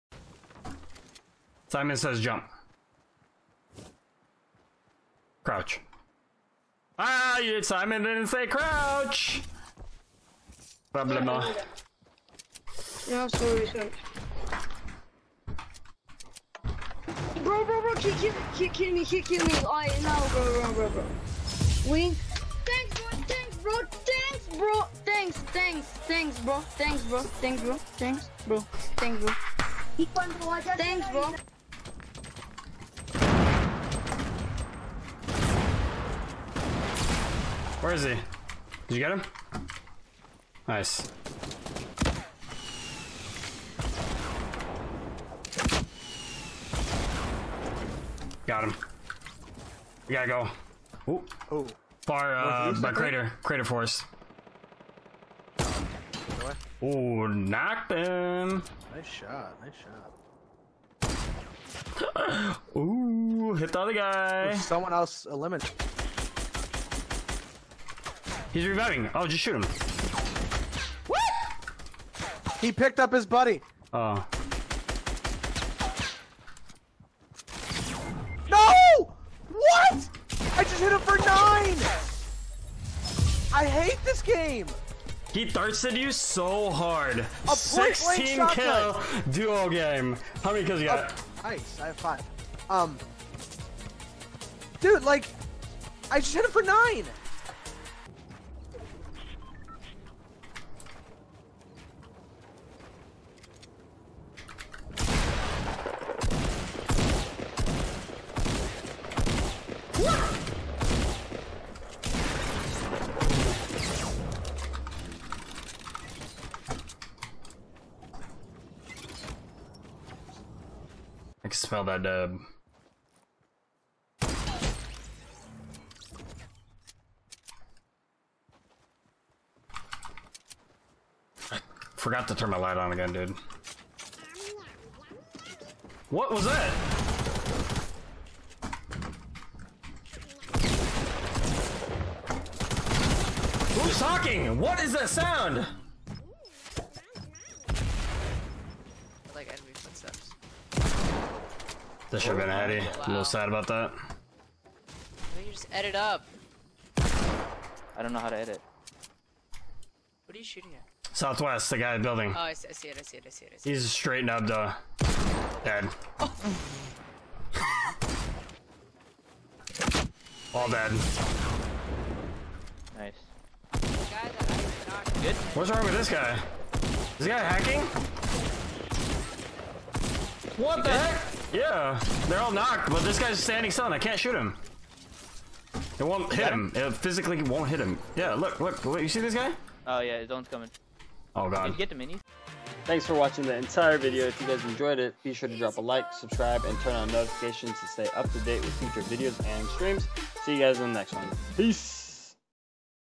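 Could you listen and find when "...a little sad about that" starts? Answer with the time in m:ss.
2:33.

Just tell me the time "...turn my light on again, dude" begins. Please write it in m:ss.
2:12.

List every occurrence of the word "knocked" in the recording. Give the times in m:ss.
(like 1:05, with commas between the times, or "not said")
0:57, 3:02.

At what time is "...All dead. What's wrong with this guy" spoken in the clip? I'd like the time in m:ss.
2:50.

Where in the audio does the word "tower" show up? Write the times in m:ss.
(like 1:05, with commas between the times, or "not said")
not said.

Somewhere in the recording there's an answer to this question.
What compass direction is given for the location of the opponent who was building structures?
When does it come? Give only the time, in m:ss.
2:41.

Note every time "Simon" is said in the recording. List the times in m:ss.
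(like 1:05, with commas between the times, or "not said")
0:01, 0:07.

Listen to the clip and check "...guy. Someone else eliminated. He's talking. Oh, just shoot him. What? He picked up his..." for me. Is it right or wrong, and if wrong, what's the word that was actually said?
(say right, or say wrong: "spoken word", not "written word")
wrong: "reviving", not "talking".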